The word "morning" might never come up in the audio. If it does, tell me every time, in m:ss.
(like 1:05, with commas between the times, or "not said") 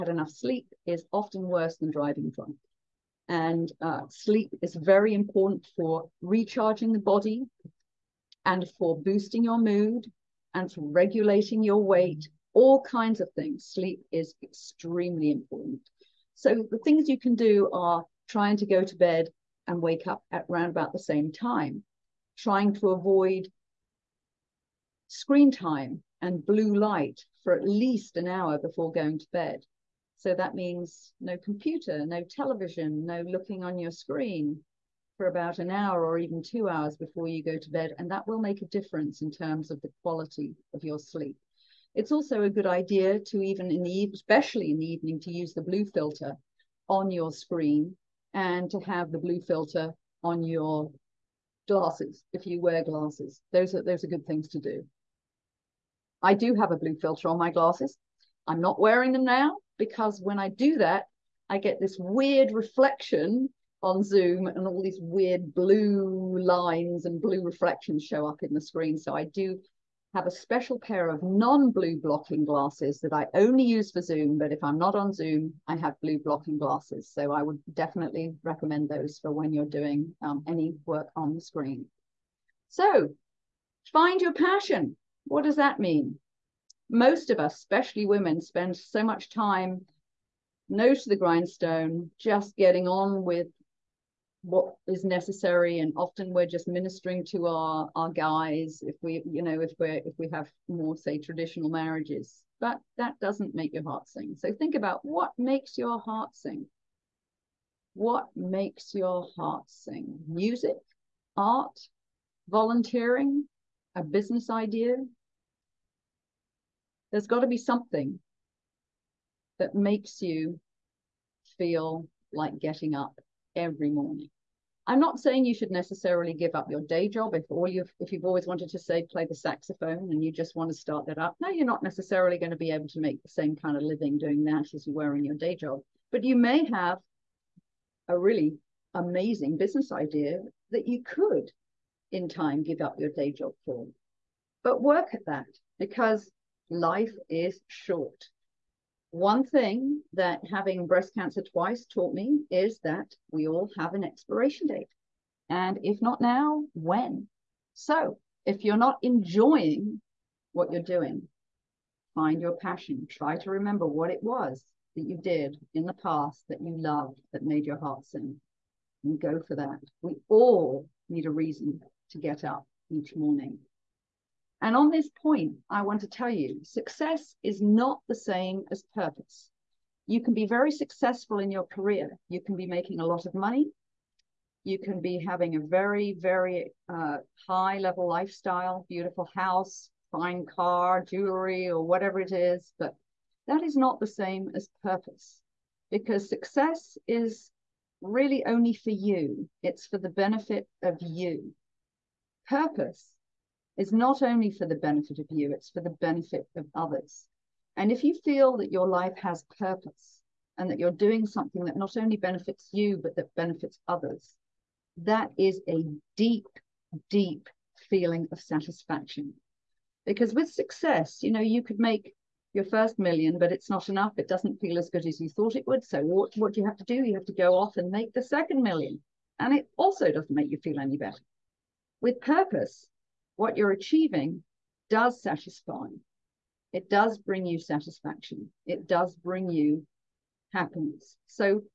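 2:03, 2:53.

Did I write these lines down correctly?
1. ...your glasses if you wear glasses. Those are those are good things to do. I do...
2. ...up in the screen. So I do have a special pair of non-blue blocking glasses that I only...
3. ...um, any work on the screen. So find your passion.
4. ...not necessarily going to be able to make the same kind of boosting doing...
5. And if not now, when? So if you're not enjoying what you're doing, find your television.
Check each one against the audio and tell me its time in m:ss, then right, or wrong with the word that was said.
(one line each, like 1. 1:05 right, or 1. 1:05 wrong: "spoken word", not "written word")
1. 0:50 right
2. 1:08 right
3. 1:20 right
4. 2:11 wrong: "living", not "boosting"
5. 2:35 wrong: "passion", not "television".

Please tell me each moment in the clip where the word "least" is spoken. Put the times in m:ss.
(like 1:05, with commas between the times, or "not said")
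0:27.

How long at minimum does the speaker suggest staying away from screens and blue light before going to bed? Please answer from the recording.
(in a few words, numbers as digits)
1 hour.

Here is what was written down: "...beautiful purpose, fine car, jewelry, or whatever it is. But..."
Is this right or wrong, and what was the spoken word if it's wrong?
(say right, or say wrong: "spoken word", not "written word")
wrong: "house", not "purpose".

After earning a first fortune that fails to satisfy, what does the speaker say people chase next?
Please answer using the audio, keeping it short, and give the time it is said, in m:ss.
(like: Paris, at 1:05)
the second million, at 3:48.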